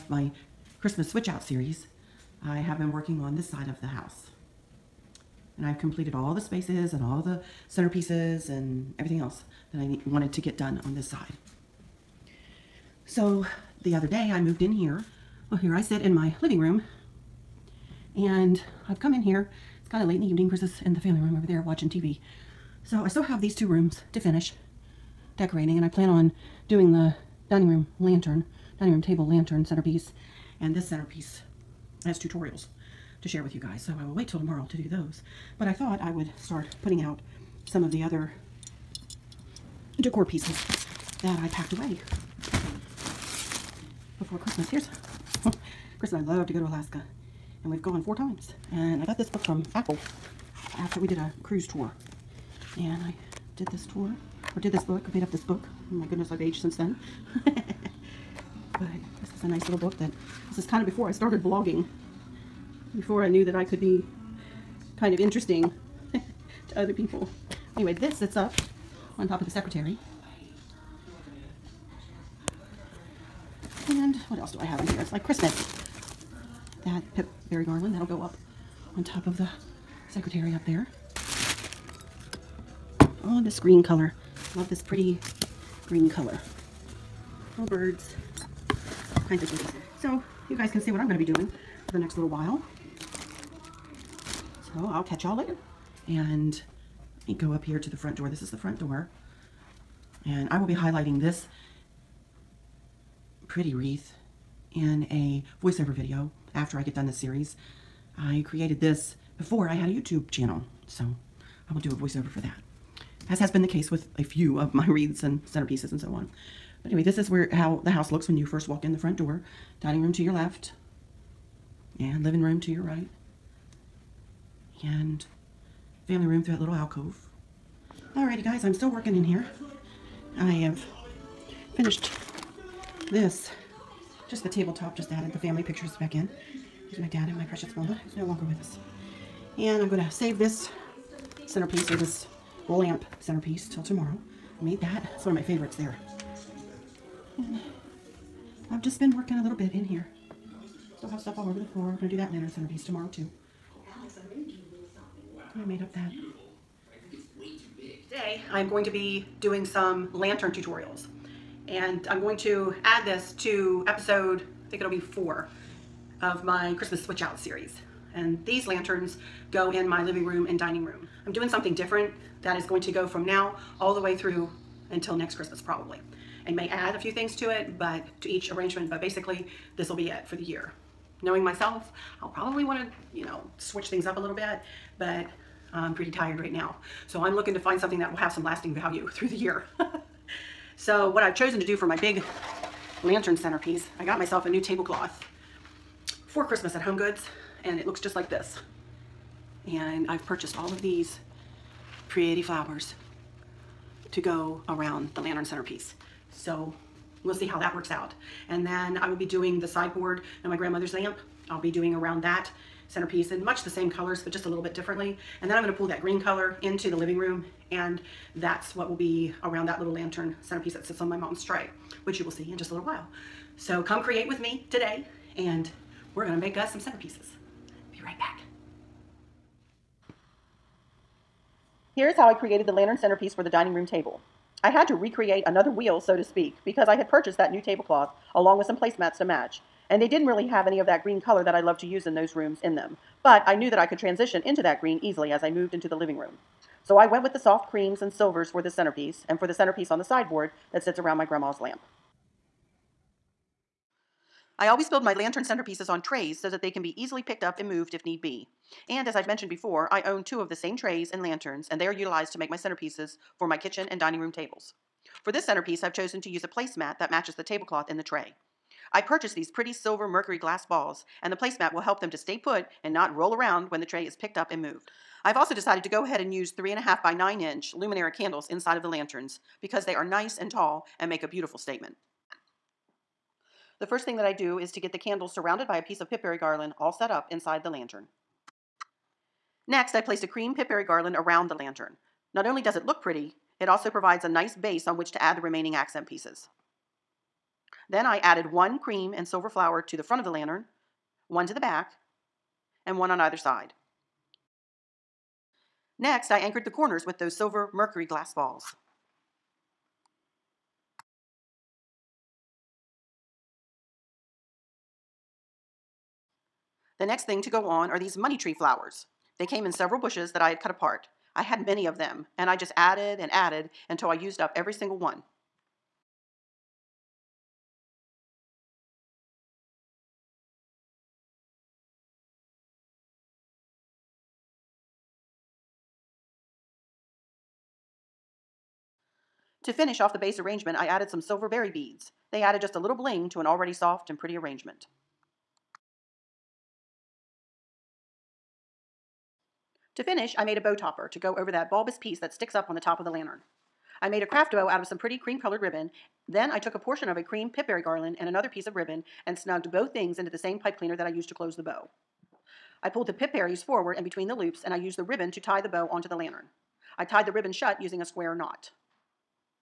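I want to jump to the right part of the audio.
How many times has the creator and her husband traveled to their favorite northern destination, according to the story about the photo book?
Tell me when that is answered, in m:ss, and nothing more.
0:48.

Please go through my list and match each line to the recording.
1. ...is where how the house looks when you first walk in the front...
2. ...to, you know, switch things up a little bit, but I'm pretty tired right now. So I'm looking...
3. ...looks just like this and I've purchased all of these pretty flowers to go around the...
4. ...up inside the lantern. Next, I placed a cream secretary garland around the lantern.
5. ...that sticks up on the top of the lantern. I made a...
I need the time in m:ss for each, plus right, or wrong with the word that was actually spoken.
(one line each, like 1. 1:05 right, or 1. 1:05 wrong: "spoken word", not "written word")
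1. 1:57 right
2. 3:02 right
3. 3:17 right
4. 4:47 wrong: "pipberry", not "secretary"
5. 5:52 right.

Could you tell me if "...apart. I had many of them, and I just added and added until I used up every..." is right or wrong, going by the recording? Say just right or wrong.
right.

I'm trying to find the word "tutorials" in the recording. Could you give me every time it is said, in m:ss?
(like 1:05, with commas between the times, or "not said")
0:32, 2:40.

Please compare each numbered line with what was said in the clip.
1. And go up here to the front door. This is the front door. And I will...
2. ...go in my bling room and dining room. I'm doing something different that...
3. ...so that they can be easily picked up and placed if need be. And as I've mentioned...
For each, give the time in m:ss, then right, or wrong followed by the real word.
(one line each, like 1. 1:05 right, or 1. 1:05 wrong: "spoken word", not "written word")
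1. 1:36 right
2. 2:49 wrong: "living", not "bling"
3. 4:16 wrong: "moved", not "placed".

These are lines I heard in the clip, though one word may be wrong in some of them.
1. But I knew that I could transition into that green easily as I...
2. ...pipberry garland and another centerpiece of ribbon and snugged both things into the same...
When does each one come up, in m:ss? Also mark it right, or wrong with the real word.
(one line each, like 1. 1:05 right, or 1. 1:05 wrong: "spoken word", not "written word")
1. 4:03 right
2. 5:57 wrong: "piece", not "centerpiece".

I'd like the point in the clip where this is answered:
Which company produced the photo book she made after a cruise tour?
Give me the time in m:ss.
0:49.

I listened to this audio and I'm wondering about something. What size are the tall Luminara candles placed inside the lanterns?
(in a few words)
3.5 by 9 inch.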